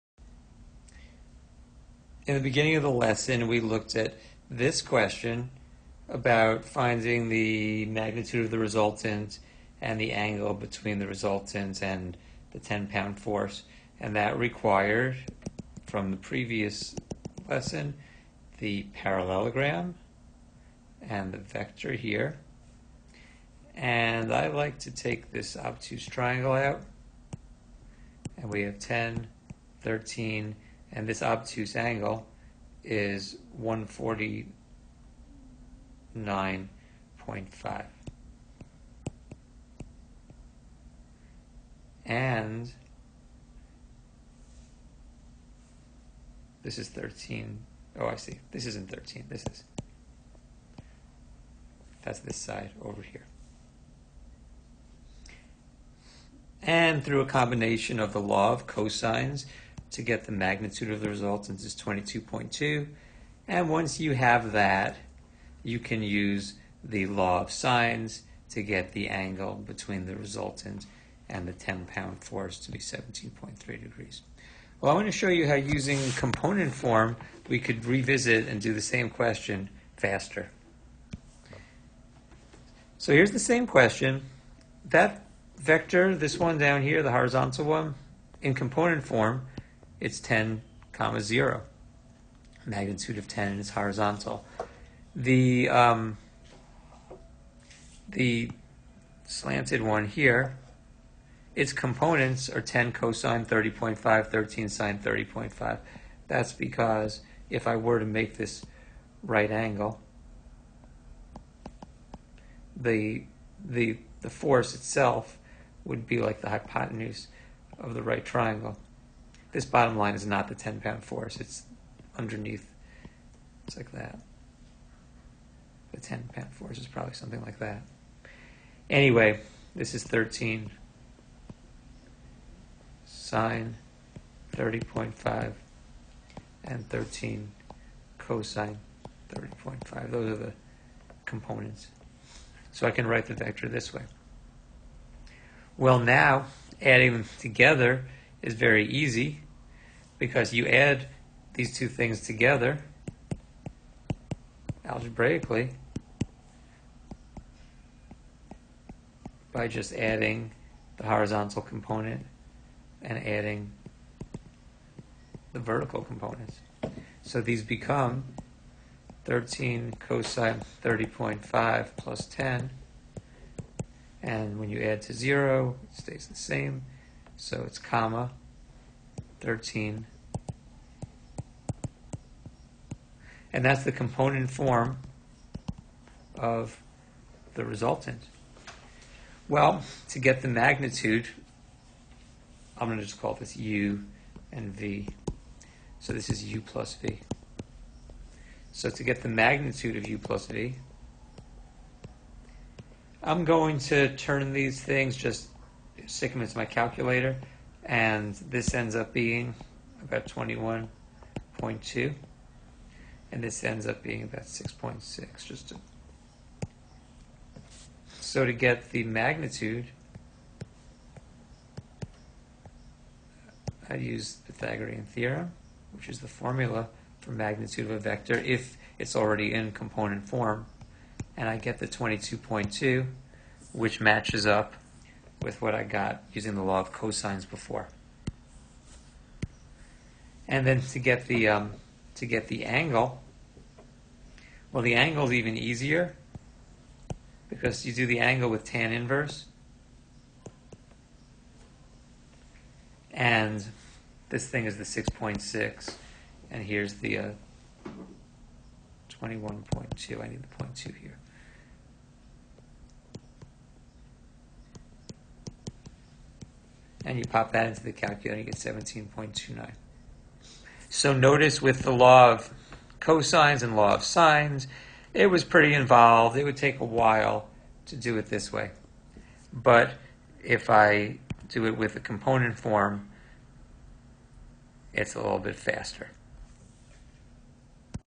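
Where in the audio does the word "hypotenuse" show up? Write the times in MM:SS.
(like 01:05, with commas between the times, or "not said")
01:56.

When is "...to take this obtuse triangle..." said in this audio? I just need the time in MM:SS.
00:24.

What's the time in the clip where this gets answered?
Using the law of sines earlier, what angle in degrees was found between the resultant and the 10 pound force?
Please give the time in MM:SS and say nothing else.
01:12.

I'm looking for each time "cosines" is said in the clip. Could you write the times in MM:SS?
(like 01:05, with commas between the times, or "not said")
00:58, 01:42, 02:18, 02:49, 03:56, 04:32.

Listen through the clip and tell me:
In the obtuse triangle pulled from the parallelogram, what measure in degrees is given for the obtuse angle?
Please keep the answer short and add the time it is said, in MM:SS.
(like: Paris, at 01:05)
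149.5, at 00:33.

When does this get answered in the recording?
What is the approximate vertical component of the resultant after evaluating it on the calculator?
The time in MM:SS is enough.
03:34.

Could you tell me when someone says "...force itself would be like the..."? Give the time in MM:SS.
01:54.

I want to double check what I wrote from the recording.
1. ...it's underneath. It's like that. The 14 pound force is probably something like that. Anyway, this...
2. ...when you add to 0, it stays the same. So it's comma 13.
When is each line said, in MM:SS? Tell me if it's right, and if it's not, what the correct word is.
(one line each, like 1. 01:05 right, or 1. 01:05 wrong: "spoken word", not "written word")
1. 02:01 wrong: "10", not "14"
2. 02:54 right.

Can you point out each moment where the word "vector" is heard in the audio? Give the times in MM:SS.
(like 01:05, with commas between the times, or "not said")
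00:21, 01:25, 02:23, 03:47.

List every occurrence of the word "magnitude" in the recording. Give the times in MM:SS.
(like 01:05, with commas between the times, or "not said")
00:07, 01:00, 01:32, 03:10, 03:19, 03:39, 03:47.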